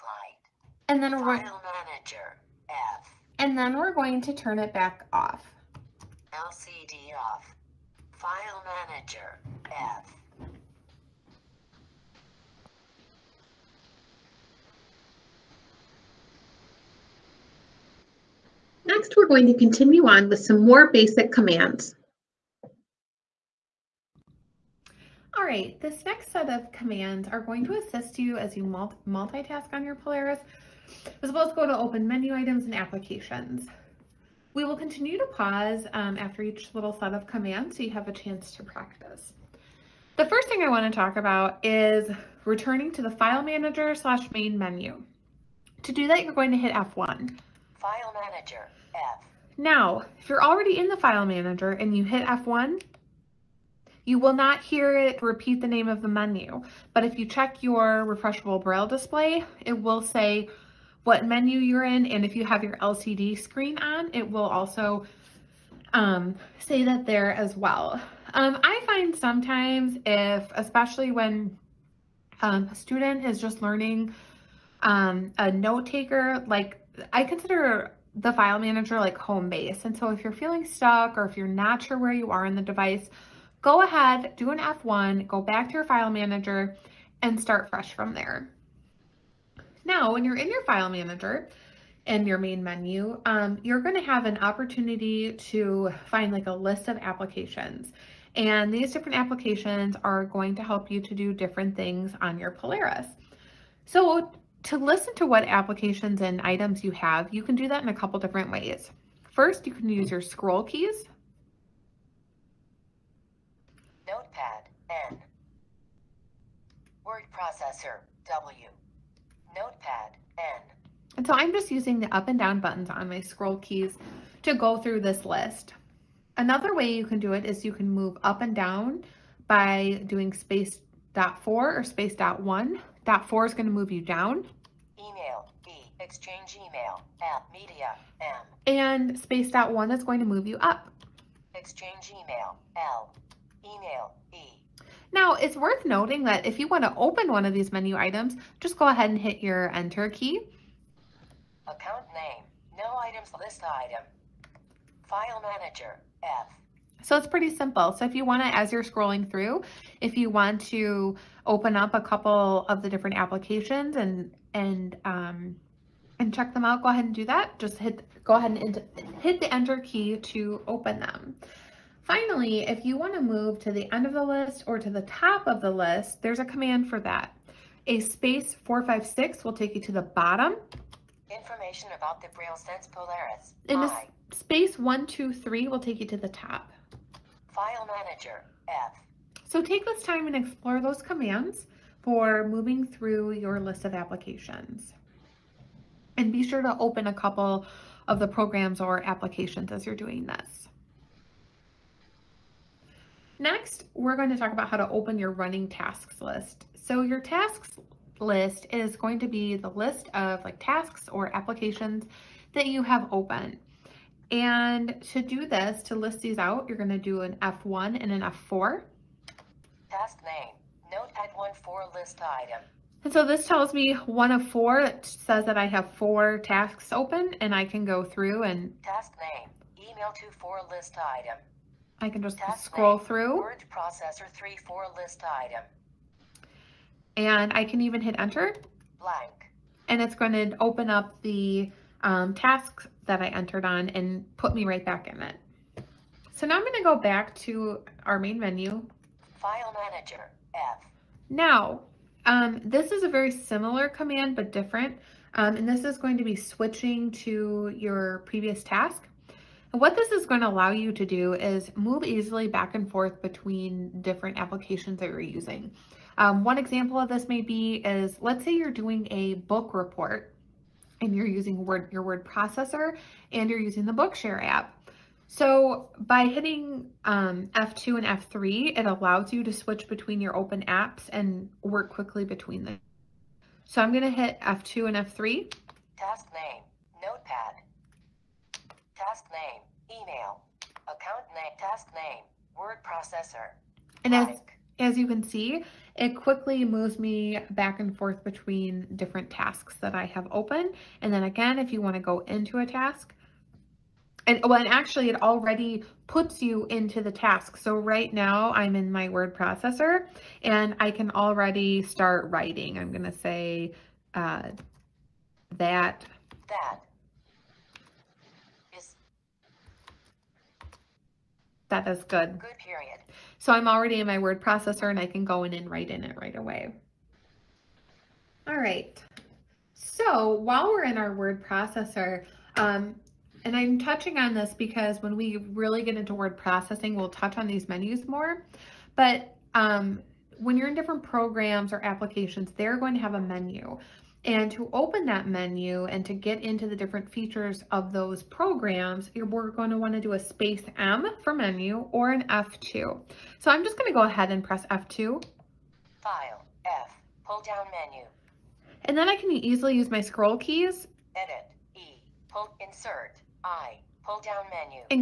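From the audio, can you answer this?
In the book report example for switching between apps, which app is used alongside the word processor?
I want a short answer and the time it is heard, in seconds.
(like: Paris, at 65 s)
Bookshare, at 273 s.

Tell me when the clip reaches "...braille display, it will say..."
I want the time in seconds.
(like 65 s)
58 s.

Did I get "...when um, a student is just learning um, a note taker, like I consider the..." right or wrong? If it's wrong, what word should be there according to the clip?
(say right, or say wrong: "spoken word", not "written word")
right.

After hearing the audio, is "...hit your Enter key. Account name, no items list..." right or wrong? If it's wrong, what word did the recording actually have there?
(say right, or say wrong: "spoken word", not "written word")
right.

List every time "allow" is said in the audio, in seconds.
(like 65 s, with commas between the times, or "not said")
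260 s, 278 s.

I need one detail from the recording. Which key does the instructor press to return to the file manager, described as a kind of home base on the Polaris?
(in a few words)
F1.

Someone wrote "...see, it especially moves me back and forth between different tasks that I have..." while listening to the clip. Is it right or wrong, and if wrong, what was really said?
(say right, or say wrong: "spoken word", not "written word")
wrong: "quickly", not "especially".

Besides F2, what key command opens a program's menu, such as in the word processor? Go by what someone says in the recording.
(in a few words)
Space M.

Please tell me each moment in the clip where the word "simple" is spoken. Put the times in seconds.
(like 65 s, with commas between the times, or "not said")
157 s.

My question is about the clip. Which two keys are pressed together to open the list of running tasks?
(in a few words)
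F1 and F4.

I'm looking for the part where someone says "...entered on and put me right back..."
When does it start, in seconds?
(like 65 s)
243 s.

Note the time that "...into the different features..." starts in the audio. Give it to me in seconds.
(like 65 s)
346 s.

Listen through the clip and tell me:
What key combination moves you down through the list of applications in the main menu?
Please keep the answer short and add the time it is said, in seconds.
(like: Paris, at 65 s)
Space dot 4, at 130 s.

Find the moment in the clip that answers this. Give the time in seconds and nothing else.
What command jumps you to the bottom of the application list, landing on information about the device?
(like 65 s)
177 s.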